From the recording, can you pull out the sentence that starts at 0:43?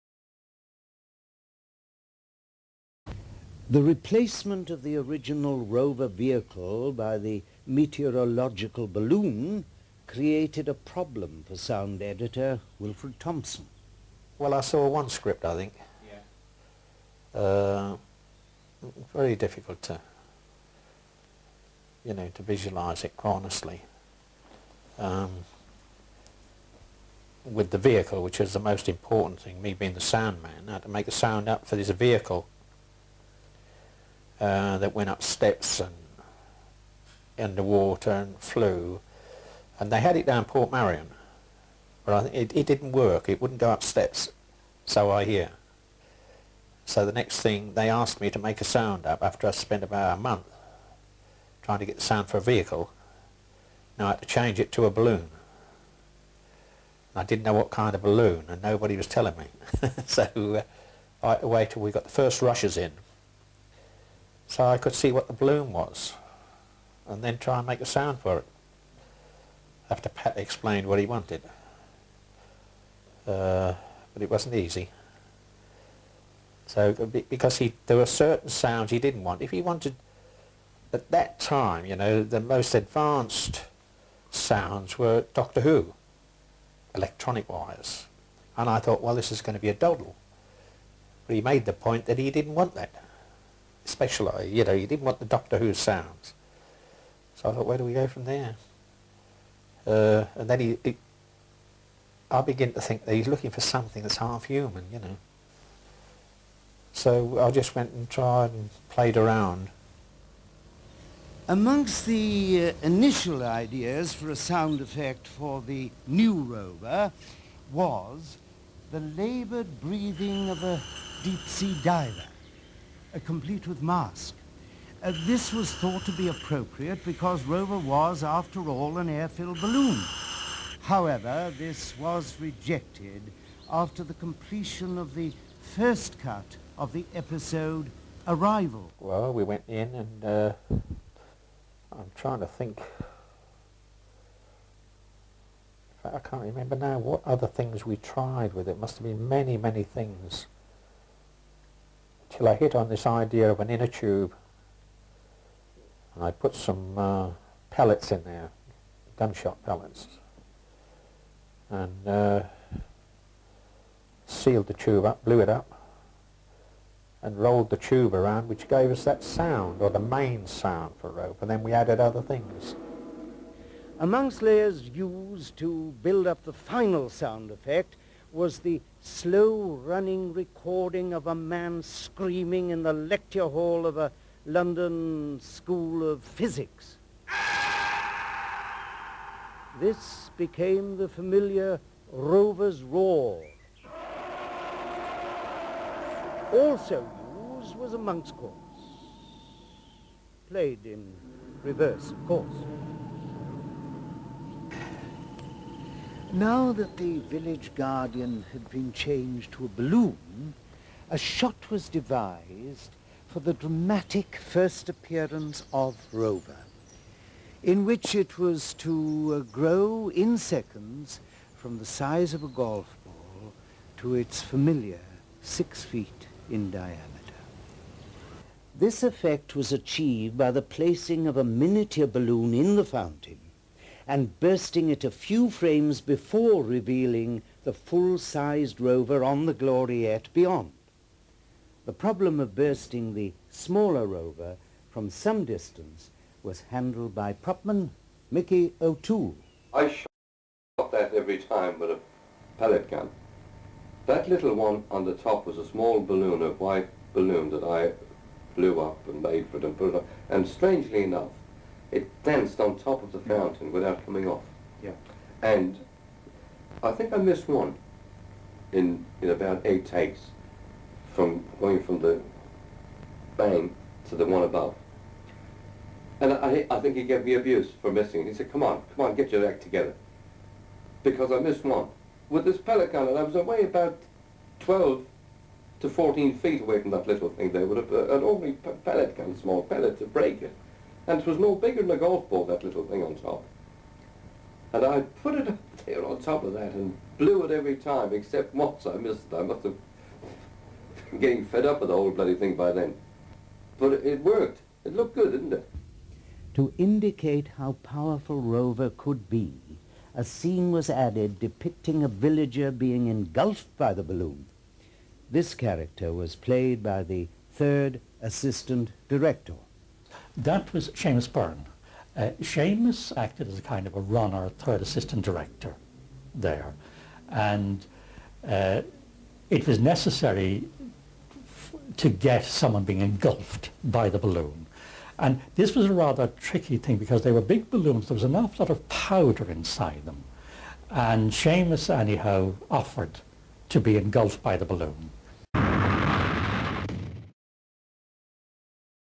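It wouldn't go up steps, so I hear.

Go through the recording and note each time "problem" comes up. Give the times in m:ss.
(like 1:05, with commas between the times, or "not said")
0:10, 4:01.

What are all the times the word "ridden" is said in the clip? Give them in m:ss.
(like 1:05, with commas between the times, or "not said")
not said.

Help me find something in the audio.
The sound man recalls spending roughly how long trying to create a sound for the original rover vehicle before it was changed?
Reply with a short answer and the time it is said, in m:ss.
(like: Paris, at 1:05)
about a month, at 0:49.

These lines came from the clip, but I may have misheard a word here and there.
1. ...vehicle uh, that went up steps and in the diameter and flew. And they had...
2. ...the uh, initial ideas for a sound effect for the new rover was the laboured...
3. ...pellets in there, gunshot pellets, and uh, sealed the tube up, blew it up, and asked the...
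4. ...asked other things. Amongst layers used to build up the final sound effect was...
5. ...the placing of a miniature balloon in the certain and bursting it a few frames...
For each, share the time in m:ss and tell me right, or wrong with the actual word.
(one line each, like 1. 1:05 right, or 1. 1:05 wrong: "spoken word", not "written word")
1. 0:31 wrong: "water", not "diameter"
2. 1:52 right
3. 2:37 wrong: "rolled", not "asked"
4. 2:51 wrong: "added", not "asked"
5. 3:50 wrong: "fountain", not "certain".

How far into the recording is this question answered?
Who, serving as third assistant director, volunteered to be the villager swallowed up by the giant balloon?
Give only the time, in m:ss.
5:20.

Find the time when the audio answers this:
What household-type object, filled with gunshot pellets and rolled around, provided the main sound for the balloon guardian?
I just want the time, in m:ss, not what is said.
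2:33.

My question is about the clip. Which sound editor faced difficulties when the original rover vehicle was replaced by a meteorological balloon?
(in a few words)
Wilfred Thompson.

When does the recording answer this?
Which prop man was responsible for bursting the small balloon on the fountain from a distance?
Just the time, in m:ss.
4:08.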